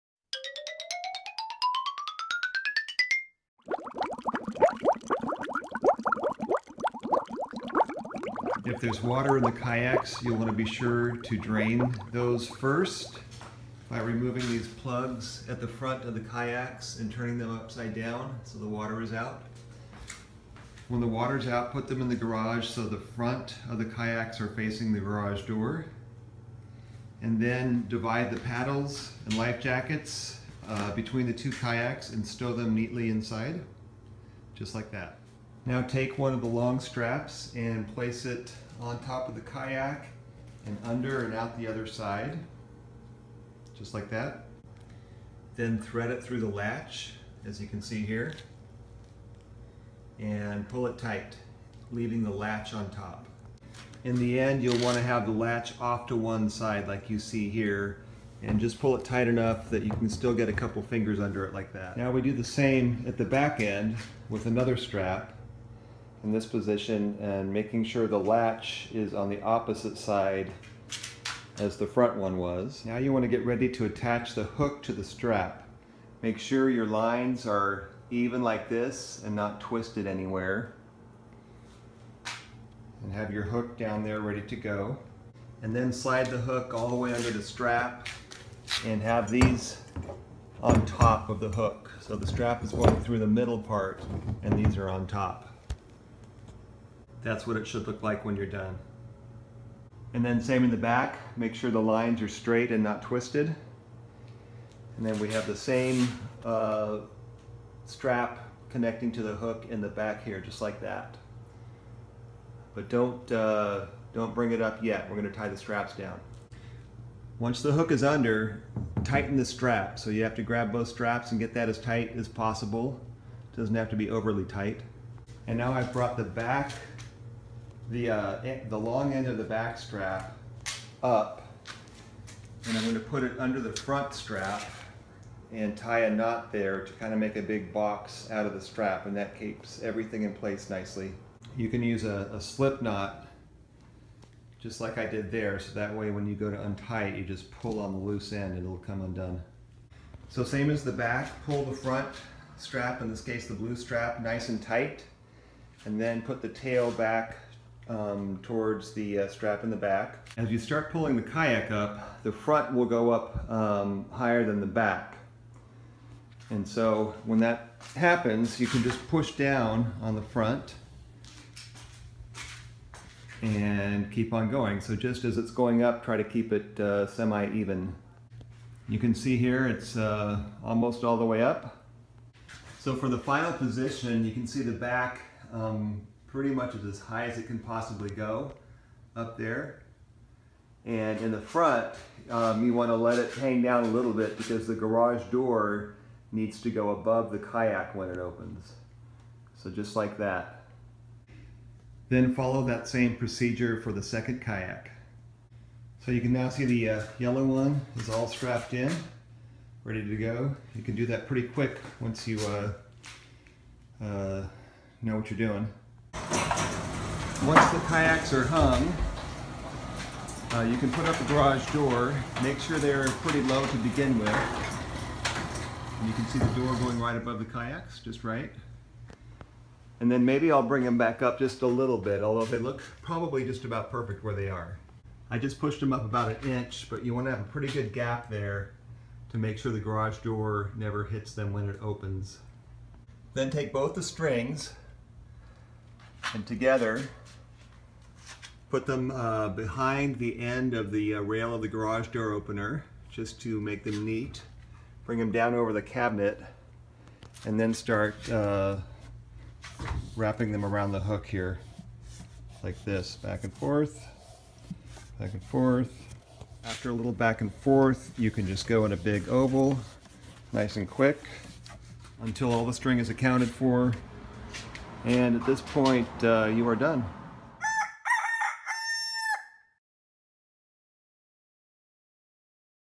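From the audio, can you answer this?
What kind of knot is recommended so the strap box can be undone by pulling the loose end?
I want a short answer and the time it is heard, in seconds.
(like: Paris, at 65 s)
slip knot, at 142 s.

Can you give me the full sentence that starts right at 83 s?
And have your hook down there ready to go.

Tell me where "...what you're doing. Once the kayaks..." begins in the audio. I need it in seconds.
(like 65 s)
215 s.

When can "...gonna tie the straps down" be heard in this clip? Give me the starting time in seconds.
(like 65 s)
115 s.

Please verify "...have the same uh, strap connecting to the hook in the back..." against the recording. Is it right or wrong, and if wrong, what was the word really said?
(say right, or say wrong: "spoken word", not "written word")
right.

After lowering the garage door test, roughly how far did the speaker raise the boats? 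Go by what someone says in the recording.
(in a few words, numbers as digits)
about an inch.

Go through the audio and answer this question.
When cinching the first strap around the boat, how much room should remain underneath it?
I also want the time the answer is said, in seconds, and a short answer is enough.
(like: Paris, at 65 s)
a couple fingers, at 60 s.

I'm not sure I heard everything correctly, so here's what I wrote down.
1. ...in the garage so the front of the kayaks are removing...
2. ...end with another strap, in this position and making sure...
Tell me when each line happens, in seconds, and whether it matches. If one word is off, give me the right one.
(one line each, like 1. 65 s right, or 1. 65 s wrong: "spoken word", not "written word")
1. 22 s wrong: "facing", not "removing"
2. 63 s right.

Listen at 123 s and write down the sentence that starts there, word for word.
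It doesn't have to be overly tight.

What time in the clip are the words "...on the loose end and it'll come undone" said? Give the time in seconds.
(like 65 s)
147 s.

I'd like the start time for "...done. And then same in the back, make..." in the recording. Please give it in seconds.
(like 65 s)
98 s.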